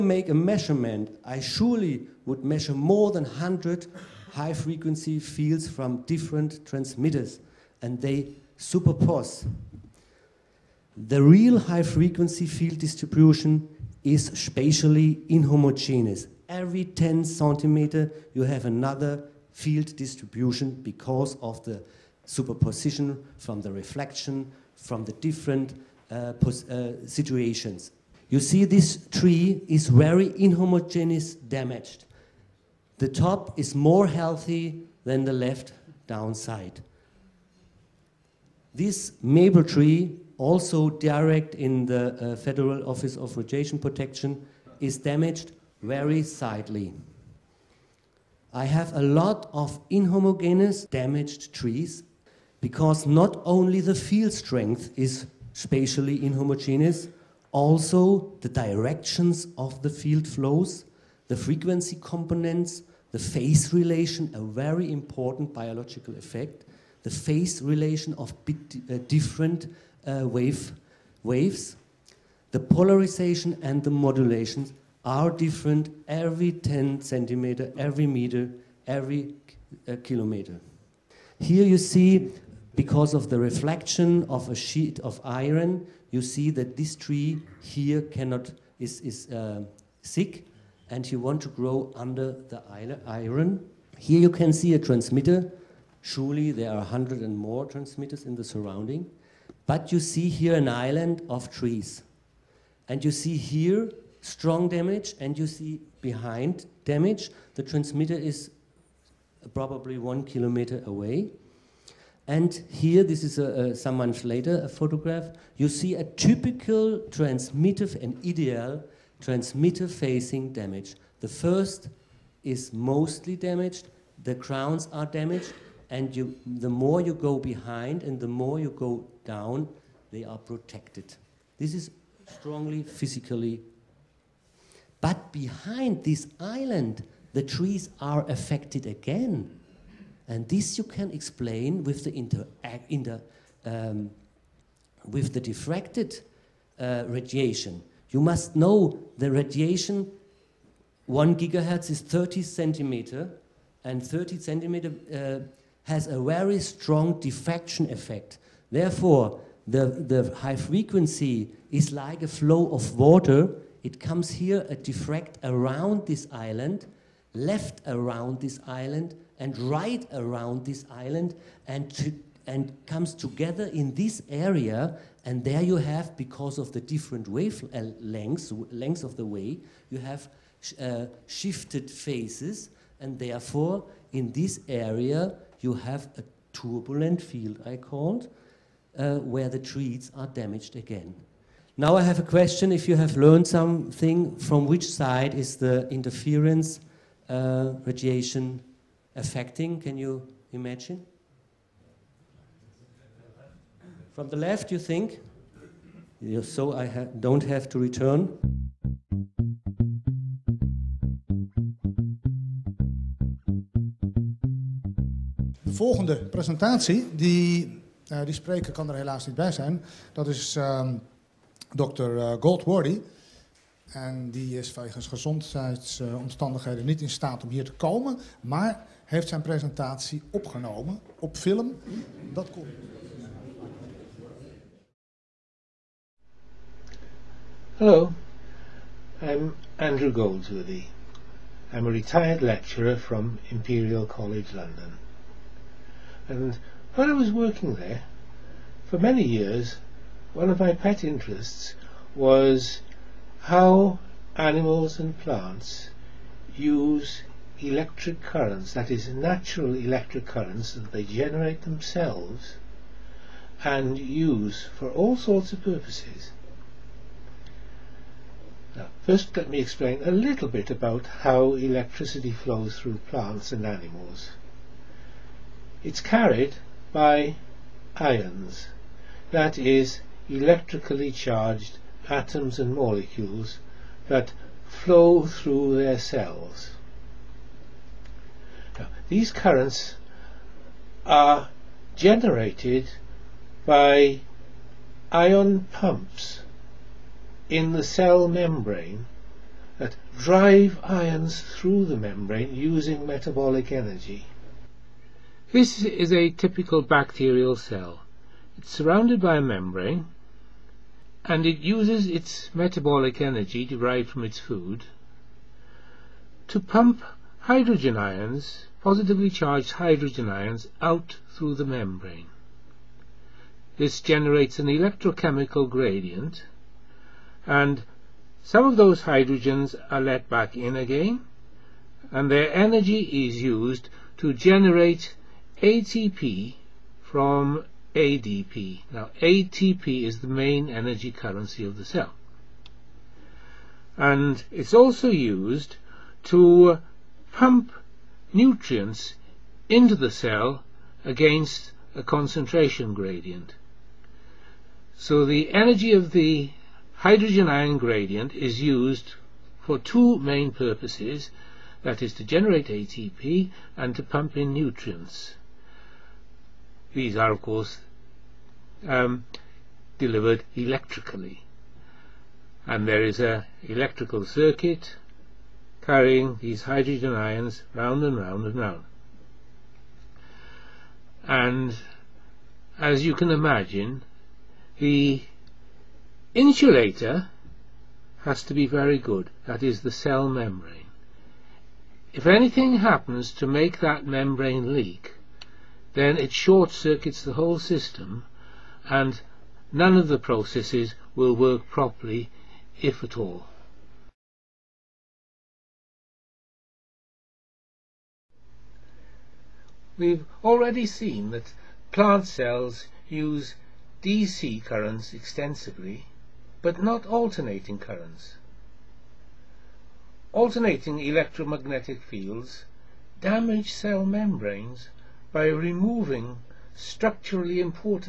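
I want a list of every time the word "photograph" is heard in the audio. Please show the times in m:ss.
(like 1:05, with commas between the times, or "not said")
1:54.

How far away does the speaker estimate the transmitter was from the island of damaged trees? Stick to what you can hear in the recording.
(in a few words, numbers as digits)
1 kilometer.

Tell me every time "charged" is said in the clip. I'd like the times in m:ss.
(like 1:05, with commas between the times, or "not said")
4:41, 5:19.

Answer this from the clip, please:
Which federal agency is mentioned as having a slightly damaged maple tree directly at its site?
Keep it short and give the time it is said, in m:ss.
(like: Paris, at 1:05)
Federal Office of Radiation Protection, at 0:42.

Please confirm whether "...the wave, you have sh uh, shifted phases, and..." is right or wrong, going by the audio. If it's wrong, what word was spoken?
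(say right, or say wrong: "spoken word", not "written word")
right.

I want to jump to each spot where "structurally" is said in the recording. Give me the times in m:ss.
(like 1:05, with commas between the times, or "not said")
7:06.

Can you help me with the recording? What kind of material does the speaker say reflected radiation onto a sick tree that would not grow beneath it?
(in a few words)
sheet of iron.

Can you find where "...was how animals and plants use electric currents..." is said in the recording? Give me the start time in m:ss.
4:12.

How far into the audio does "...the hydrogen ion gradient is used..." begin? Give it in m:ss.
5:56.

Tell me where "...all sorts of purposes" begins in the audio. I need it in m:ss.
4:24.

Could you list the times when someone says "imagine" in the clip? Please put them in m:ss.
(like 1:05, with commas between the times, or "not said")
3:20, 6:23.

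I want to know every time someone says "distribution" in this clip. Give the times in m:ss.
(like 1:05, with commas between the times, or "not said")
0:12, 0:19.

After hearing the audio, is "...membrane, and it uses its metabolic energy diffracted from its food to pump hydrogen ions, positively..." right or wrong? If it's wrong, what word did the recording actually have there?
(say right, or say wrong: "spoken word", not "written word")
wrong: "derived", not "diffracted".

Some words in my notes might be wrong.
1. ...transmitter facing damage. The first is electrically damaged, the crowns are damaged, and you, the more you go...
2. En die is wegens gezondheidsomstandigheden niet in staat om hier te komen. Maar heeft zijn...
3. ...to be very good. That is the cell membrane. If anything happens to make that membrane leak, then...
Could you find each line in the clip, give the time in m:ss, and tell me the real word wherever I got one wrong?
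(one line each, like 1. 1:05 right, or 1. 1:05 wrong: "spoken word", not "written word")
1. 1:59 wrong: "mostly", not "electrically"
2. 3:43 right
3. 6:28 right.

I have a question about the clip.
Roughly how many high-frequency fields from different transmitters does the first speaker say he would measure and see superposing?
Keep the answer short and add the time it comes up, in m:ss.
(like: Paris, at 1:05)
more than 100, at 0:02.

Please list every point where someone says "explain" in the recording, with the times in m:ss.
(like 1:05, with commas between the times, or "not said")
2:21, 4:29.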